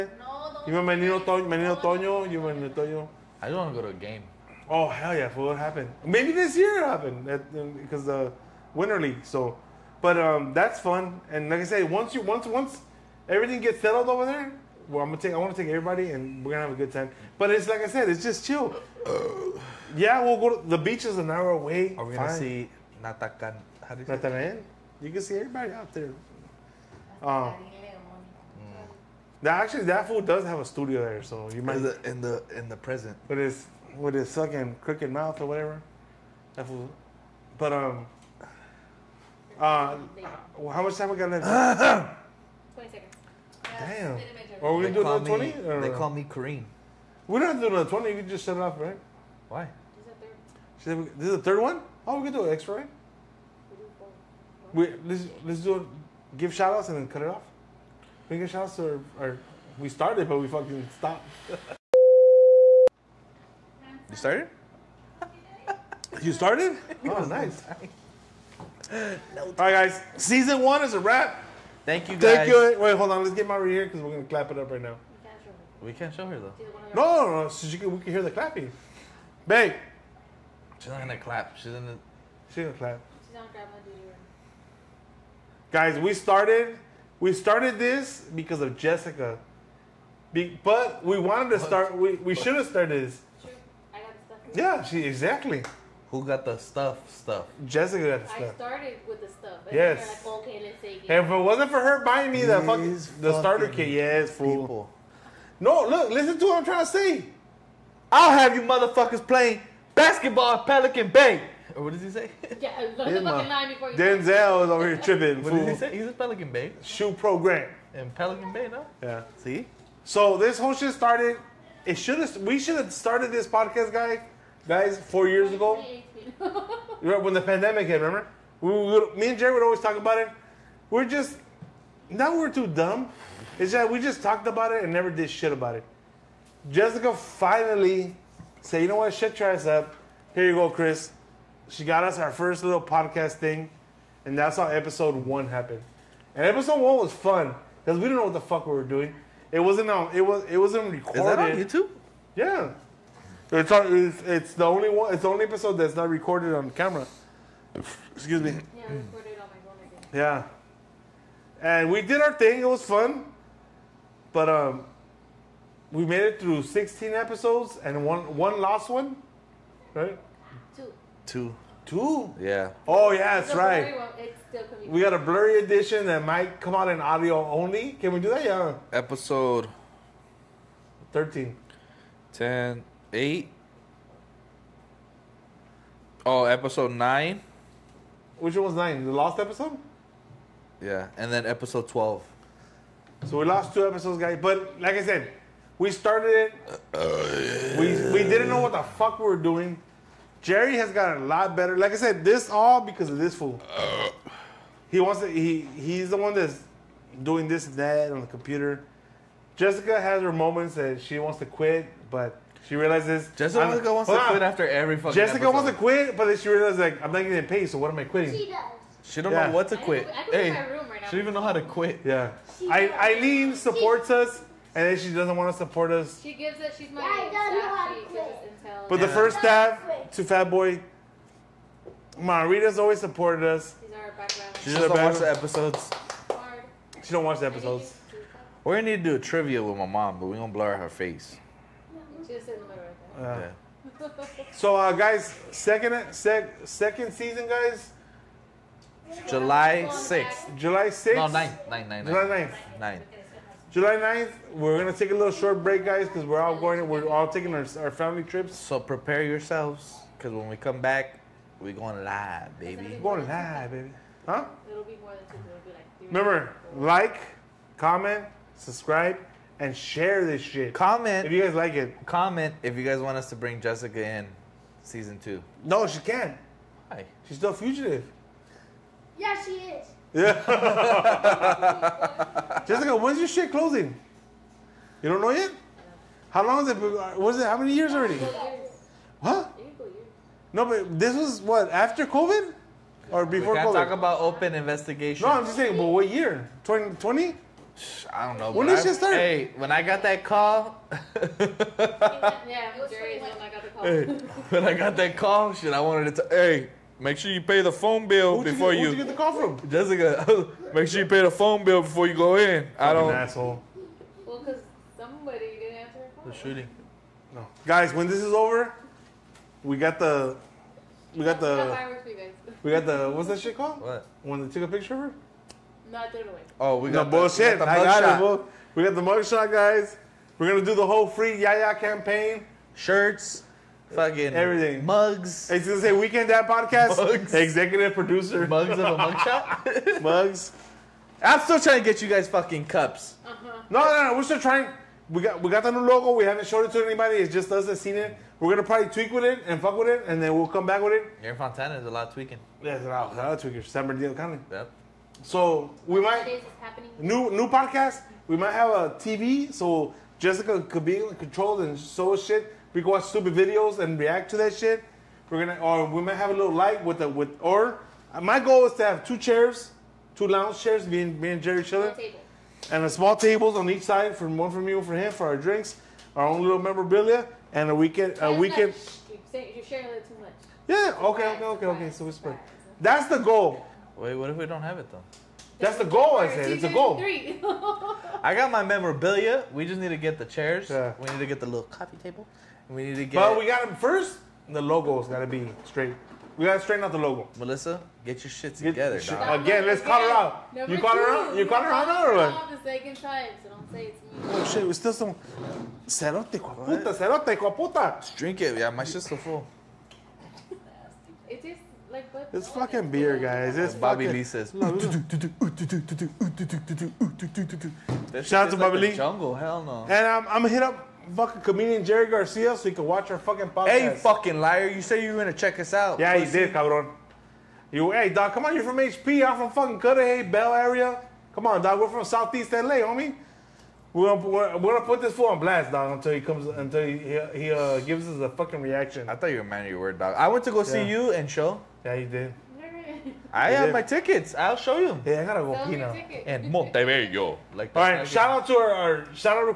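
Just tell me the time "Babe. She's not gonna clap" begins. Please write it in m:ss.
1:19.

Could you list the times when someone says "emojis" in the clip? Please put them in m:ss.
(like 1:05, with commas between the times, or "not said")
not said.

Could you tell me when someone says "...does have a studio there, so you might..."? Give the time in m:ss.
0:30.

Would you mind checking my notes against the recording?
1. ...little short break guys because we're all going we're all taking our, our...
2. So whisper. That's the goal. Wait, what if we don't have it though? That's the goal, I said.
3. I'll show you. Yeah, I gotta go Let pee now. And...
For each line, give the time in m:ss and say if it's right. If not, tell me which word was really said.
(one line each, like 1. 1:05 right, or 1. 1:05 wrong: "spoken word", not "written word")
1. 4:15 right
2. 6:21 right
3. 7:24 wrong: "Pino", not "Let".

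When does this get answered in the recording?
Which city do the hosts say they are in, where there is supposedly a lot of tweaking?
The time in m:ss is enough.
5:51.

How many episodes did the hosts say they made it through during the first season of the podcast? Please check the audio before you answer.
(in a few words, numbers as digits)
16.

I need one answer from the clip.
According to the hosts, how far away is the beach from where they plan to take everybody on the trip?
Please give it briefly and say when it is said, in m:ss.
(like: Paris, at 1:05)
An hour, at 0:21.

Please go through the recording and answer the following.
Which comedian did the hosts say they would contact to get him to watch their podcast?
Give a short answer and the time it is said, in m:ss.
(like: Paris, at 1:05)
Jerry Garcia, at 7:01.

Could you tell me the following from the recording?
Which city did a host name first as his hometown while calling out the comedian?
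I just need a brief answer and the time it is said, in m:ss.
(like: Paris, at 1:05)
Cudahy, at 7:09.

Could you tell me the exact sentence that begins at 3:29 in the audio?
Jessica has her moments that she wants to quit, but she realizes Jessica I'm, wants to quit after every fucking.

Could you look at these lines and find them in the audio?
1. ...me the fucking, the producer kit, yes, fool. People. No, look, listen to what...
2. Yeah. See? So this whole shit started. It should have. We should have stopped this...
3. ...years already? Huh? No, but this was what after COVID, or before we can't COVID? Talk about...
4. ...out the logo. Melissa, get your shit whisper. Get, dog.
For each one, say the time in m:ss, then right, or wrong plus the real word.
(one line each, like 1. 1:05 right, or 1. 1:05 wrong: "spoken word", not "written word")
1. 1:42 wrong: "starter", not "producer"
2. 1:59 wrong: "started", not "stopped"
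3. 4:47 right
4. 6:36 wrong: "together", not "whisper".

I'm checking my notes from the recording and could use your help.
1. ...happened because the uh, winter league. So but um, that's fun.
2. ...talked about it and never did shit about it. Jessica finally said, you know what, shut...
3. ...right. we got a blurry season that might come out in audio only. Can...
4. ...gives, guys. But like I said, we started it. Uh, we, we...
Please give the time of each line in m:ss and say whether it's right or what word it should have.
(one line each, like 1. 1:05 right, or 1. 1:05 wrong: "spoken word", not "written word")
1. 0:06 right
2. 2:14 right
3. 2:53 wrong: "edition", not "season"
4. 3:13 wrong: "episodes", not "gives".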